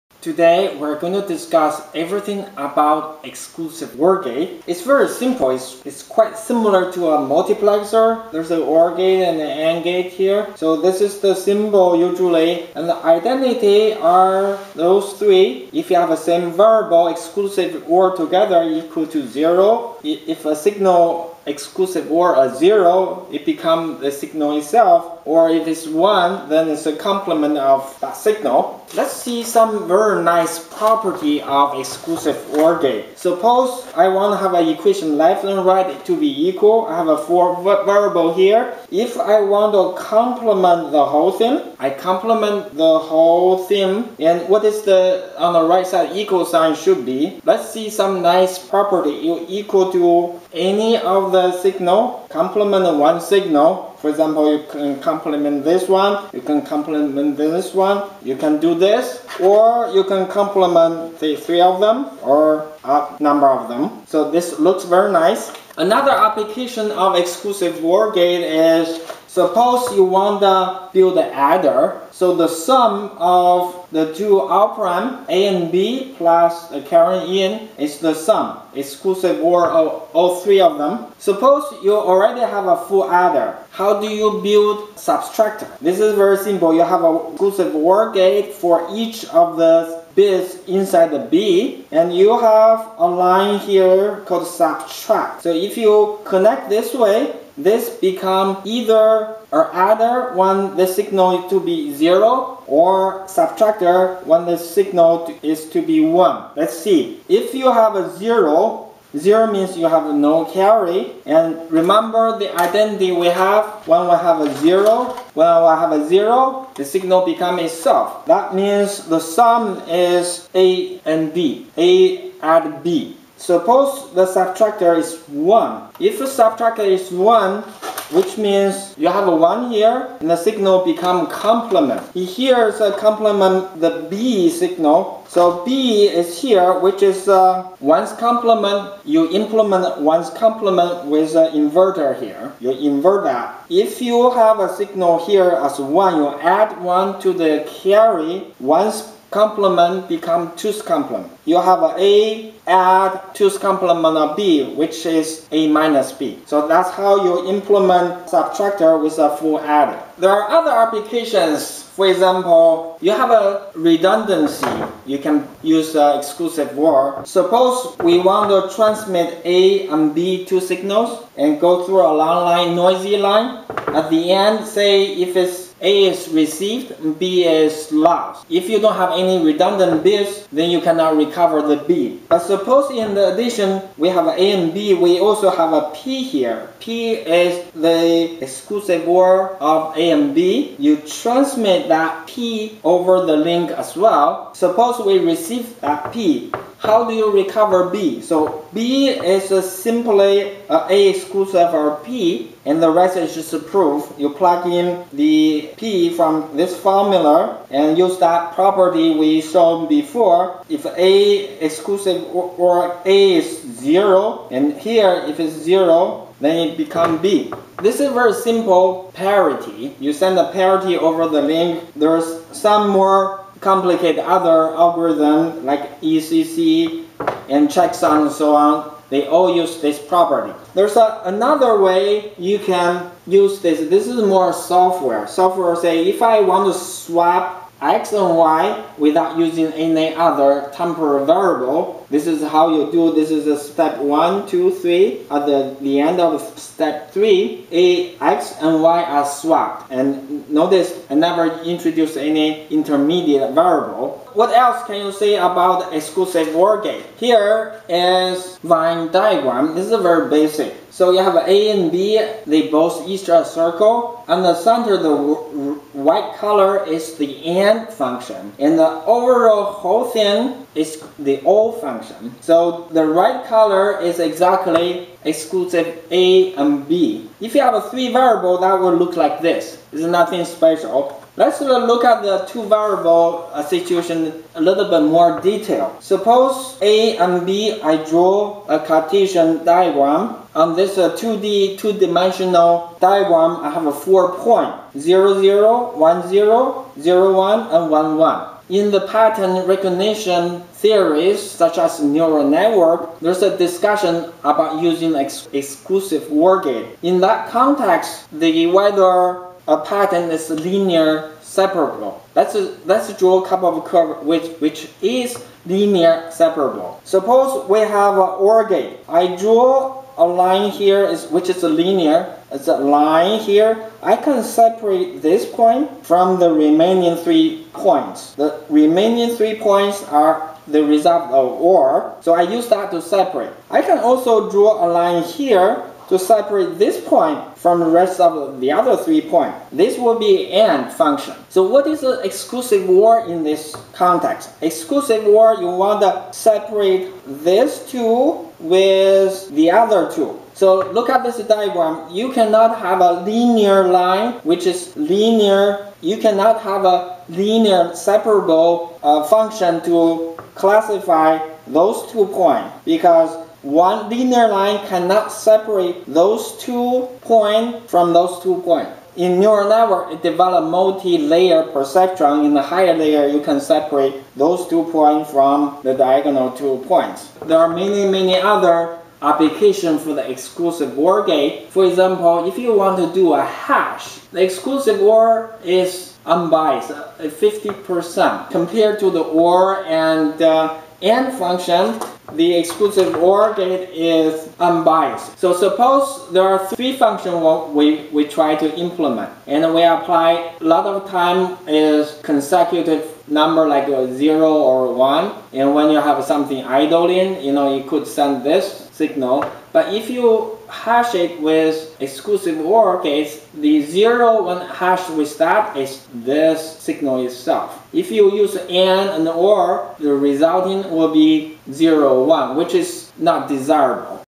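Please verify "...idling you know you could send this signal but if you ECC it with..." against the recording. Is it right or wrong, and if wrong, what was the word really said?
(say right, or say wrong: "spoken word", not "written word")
wrong: "Hash", not "ECC".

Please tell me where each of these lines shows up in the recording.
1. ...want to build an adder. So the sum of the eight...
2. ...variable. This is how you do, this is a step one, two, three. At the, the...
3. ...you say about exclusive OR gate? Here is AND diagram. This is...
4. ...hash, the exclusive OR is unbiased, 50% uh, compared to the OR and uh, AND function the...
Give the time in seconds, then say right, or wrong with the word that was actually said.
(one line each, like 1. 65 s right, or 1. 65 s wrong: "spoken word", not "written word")
1. 70 s wrong: "two", not "eight"
2. 241 s right
3. 255 s wrong: "Venn", not "AND"
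4. 383 s right.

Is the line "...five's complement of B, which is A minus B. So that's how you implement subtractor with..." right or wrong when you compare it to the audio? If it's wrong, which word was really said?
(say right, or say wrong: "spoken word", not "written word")
wrong: "two", not "five".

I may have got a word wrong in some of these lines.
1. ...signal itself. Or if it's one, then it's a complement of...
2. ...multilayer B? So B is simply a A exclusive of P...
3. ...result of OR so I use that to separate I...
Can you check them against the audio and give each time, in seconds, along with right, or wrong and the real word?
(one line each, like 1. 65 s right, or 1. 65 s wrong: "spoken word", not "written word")
1. 24 s right
2. 197 s wrong: "recover", not "multilayer"
3. 330 s right.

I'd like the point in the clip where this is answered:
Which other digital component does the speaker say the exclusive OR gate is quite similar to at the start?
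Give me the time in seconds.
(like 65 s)
7 s.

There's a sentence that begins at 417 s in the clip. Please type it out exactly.
If you use AND and OR, the resulting will be 0, 1, which is not desirable.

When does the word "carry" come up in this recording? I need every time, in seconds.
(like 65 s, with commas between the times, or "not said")
110 s, 147 s.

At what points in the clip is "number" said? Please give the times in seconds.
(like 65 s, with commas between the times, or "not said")
63 s, 403 s.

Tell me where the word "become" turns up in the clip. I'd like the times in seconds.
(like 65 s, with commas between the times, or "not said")
23 s, 97 s, 117 s, 130 s, 150 s, 216 s.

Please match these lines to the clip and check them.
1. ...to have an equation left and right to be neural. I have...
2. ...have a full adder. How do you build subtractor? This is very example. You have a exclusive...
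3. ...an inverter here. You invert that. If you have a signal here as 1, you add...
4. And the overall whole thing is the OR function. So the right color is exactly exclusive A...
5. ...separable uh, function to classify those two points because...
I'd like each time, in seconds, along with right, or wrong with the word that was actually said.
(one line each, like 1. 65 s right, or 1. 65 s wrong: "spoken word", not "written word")
1. 34 s wrong: "equal", not "neural"
2. 82 s wrong: "simple", not "example"
3. 141 s right
4. 268 s right
5. 357 s right.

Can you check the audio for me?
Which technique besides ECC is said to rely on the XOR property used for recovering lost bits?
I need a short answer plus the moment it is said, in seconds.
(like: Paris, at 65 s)
checksum, at 227 s.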